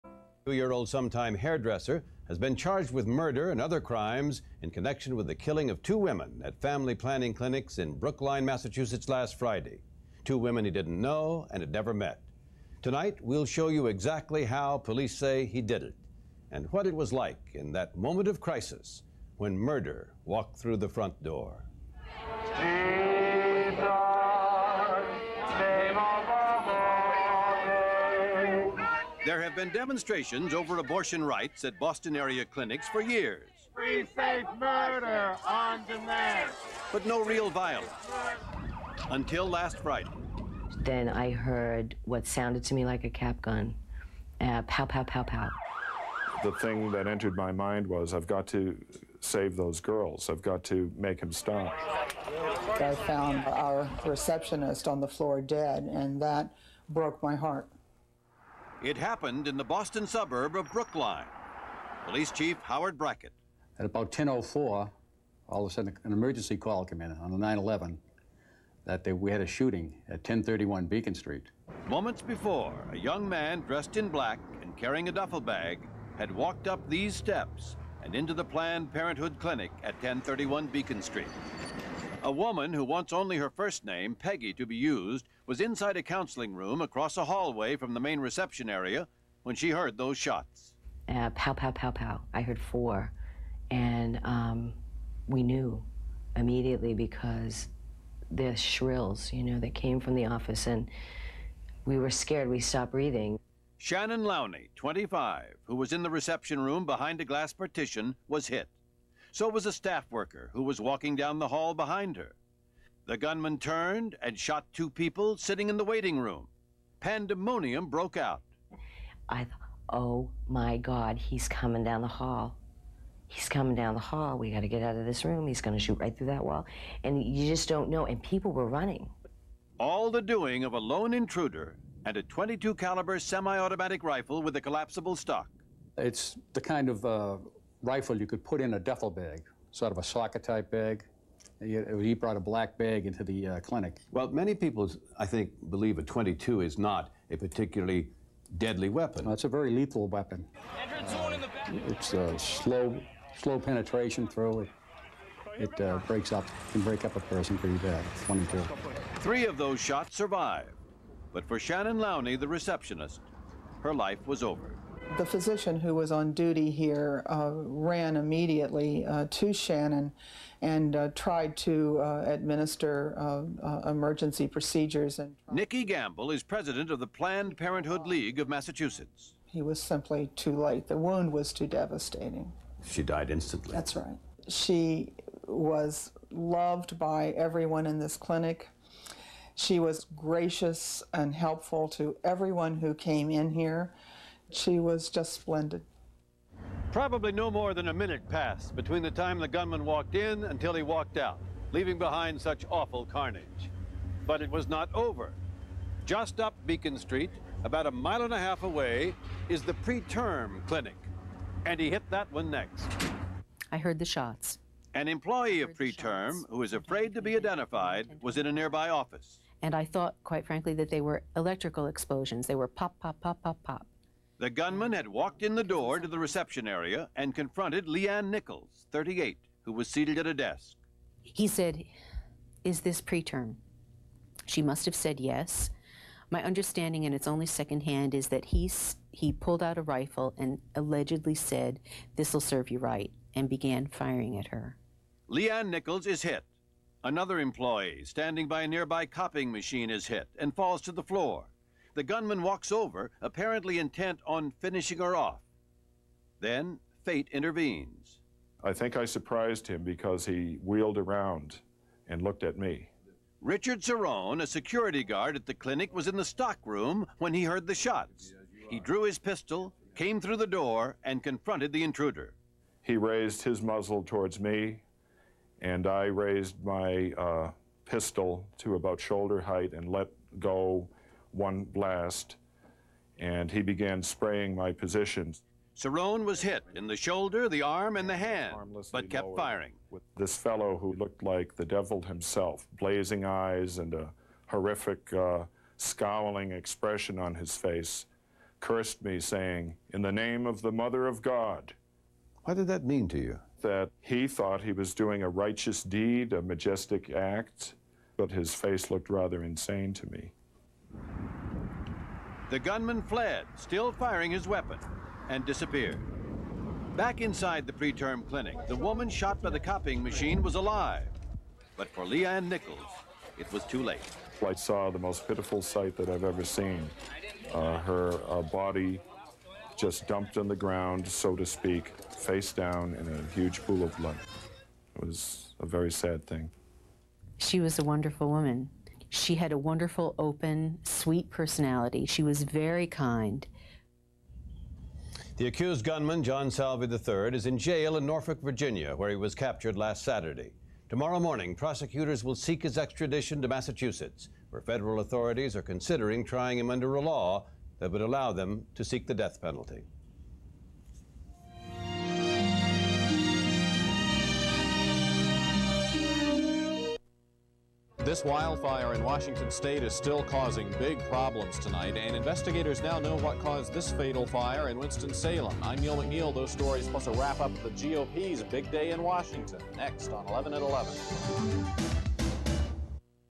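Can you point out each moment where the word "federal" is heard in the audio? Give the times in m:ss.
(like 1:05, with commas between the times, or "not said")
5:54.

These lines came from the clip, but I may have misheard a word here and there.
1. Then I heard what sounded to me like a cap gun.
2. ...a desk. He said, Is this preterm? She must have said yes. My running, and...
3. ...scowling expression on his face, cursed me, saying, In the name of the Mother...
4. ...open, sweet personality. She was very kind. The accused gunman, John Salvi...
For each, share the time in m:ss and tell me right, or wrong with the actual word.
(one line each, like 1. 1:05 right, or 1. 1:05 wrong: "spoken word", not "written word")
1. 0:40 right
2. 3:50 wrong: "understanding", not "running"
3. 4:55 right
4. 5:40 right.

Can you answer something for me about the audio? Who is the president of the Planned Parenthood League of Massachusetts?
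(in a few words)
Nicki Gamble.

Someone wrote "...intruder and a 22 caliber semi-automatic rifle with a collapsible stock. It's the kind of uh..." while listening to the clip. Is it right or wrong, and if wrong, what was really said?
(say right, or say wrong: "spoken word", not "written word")
right.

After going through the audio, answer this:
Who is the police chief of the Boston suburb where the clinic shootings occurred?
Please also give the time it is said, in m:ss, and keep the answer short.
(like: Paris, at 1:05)
Howard Brackett, at 1:02.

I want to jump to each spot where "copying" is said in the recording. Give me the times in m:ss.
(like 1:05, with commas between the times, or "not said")
4:09, 5:19.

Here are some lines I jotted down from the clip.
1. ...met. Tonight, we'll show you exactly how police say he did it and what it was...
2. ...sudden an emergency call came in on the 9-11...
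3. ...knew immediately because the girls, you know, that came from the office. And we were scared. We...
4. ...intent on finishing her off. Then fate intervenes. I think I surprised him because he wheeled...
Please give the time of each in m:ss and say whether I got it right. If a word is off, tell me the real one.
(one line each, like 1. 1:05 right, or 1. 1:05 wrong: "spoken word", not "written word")
1. 0:11 right
2. 1:05 right
3. 1:35 wrong: "shrills", not "girls"
4. 4:13 right.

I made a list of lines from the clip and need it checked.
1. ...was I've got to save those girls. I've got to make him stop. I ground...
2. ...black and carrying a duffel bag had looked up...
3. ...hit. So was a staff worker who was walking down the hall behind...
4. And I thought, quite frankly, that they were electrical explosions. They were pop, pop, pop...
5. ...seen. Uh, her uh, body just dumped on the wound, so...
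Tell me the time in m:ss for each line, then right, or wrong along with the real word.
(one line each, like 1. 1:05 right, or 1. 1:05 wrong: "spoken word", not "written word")
1. 0:47 wrong: "found", not "ground"
2. 1:14 wrong: "walked", not "looked"
3. 1:48 right
4. 3:39 right
5. 5:26 wrong: "ground", not "wound".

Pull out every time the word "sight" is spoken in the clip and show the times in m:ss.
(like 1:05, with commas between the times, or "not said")
5:25.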